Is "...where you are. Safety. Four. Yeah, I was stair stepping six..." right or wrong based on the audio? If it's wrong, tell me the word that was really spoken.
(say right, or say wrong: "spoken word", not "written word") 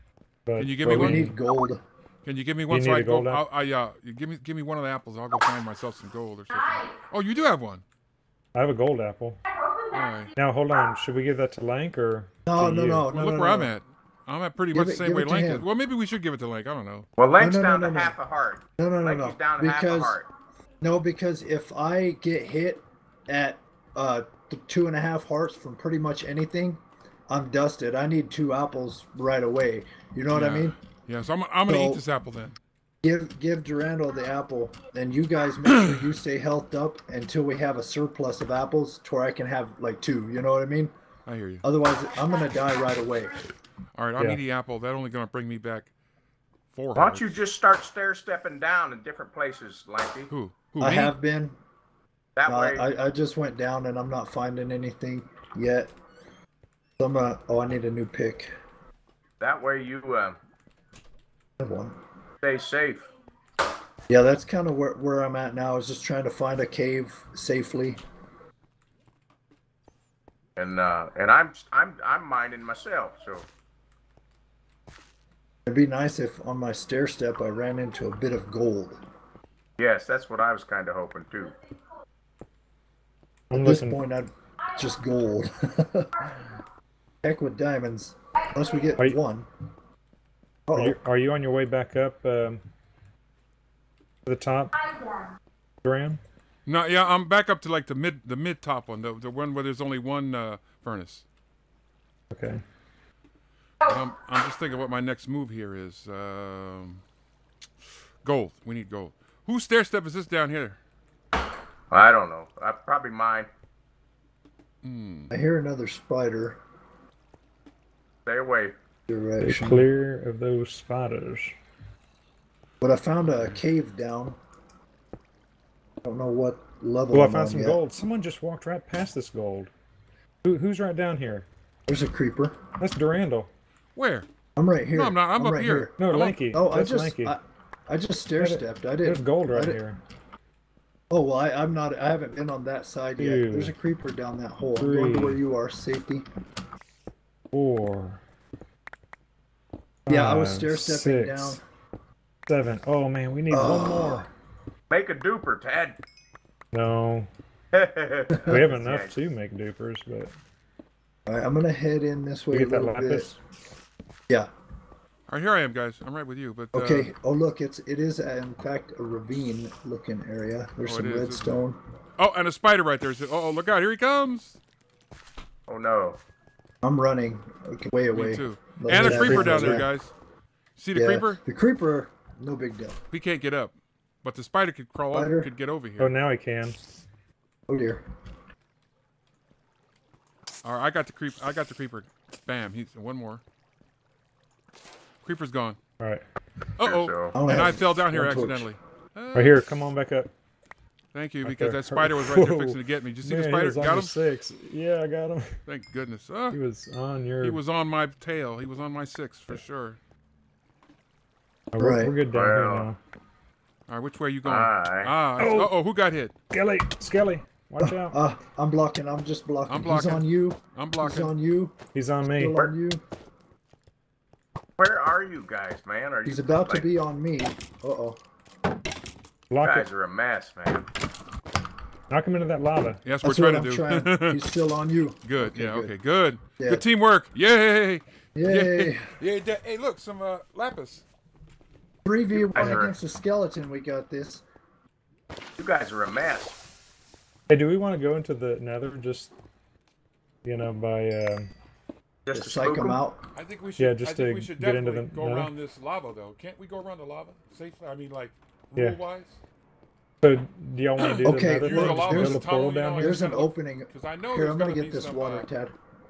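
right.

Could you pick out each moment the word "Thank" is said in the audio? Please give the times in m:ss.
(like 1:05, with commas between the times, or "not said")
3:21, 3:25.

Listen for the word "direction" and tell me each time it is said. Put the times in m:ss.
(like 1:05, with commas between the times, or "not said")
1:59.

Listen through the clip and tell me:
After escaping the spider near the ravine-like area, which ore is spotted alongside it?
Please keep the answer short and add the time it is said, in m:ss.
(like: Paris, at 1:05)
Redstone, at 2:51.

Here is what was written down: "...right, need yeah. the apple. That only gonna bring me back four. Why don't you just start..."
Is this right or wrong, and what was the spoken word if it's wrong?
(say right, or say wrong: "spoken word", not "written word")
right.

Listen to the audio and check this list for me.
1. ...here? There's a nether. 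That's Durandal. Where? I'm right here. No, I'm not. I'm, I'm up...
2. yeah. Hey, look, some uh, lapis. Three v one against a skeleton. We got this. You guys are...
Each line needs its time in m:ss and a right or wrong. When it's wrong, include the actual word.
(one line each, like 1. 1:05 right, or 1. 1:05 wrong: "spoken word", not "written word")
1. 2:11 wrong: "creeper", not "nether"
2. 3:59 right.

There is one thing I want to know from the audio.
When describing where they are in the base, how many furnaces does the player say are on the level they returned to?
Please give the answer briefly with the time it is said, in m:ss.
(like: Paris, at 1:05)
1, at 1:39.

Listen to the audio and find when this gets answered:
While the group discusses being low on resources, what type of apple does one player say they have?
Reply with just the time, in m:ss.
0:08.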